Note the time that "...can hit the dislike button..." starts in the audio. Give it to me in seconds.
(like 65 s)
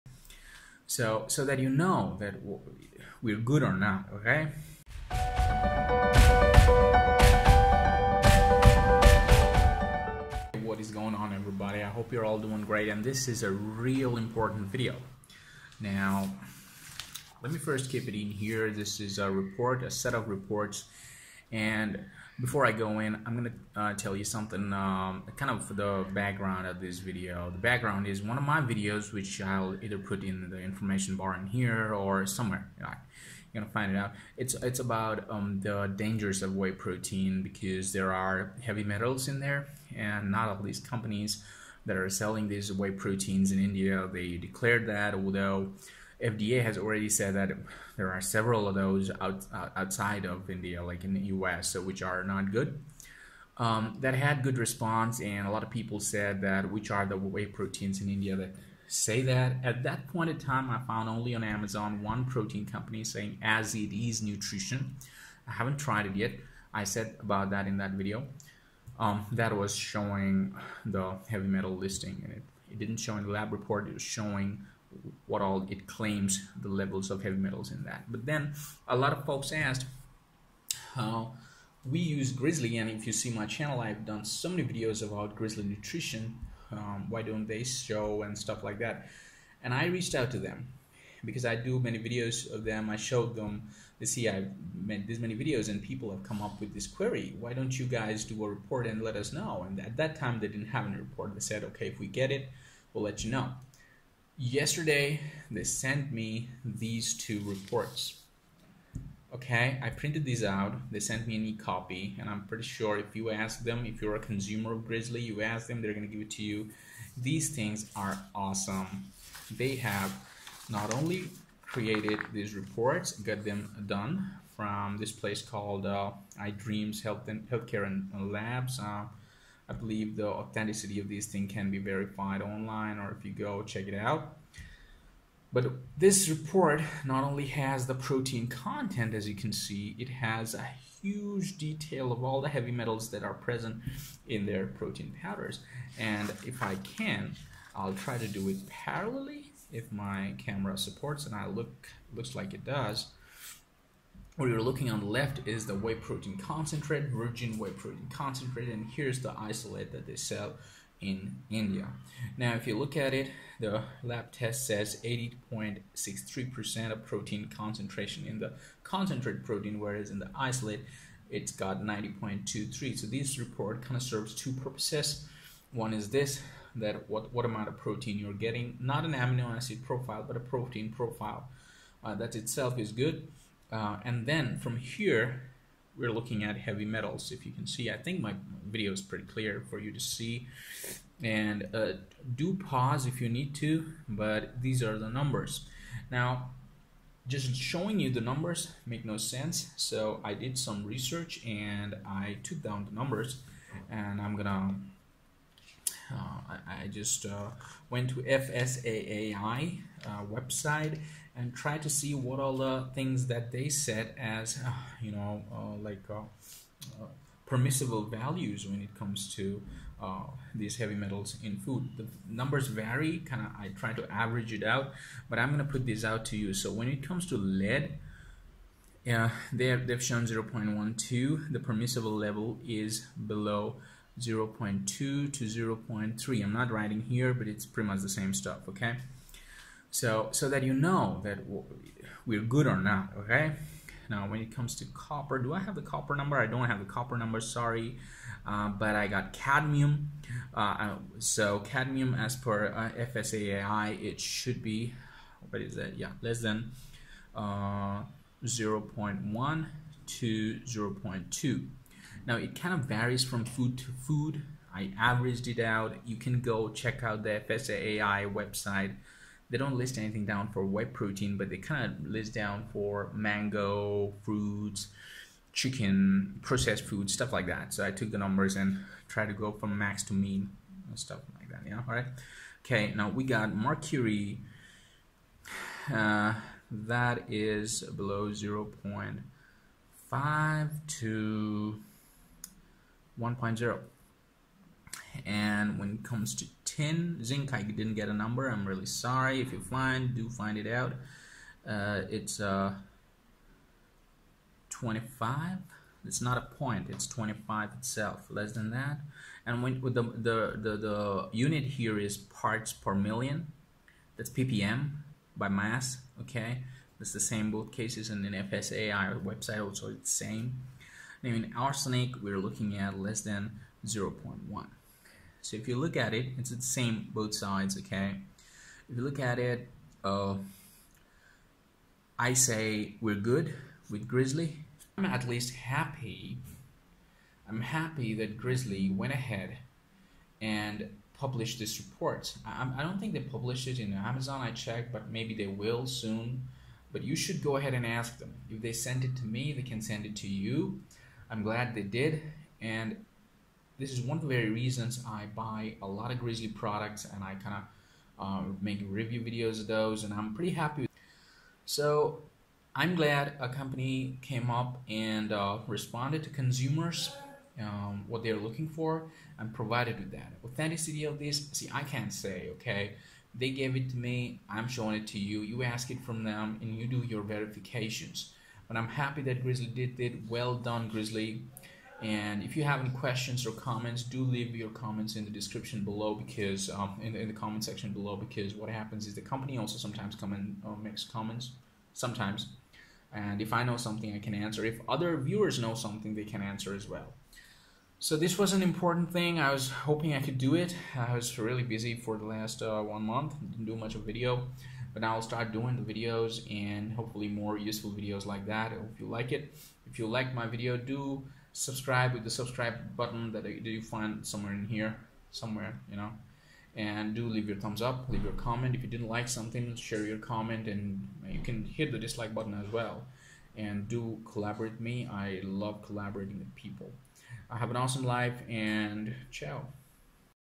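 421 s.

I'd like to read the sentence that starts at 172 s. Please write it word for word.
So this report kind of serves two purposes.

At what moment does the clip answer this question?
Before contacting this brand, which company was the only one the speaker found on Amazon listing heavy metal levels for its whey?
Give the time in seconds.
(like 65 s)
63 s.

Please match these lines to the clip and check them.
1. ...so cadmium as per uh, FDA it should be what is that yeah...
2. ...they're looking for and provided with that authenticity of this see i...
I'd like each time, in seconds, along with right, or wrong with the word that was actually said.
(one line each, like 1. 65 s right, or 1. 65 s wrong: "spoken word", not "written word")
1. 251 s wrong: "FSSAI", not "FDA"
2. 368 s right.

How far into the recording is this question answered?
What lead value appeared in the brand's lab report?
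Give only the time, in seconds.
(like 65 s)
230 s.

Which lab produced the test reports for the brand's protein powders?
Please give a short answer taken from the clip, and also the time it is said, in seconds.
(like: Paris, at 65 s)
iDreams Health and Healthcare and Labs, at 126 s.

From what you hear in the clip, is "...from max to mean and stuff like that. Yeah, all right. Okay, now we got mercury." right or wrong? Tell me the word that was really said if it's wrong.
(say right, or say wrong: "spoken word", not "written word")
right.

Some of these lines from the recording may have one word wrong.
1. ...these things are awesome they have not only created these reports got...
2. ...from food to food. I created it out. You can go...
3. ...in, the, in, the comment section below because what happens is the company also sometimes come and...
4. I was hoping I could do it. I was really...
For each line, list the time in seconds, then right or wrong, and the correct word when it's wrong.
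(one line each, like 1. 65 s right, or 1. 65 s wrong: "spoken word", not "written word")
1. 117 s right
2. 263 s wrong: "averaged", not "created"
3. 387 s right
4. 399 s right.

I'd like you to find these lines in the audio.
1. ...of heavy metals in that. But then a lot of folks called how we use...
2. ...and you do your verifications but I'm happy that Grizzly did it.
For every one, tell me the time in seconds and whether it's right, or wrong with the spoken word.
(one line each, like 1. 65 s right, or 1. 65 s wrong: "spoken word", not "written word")
1. 77 s wrong: "asked", not "called"
2. 376 s right.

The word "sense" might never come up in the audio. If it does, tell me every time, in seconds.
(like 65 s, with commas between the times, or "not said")
199 s.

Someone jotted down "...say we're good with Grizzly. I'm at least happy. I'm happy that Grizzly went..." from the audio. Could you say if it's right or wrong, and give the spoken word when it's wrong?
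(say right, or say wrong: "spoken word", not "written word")
right.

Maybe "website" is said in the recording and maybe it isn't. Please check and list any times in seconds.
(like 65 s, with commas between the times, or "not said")
210 s, 268 s, 319 s.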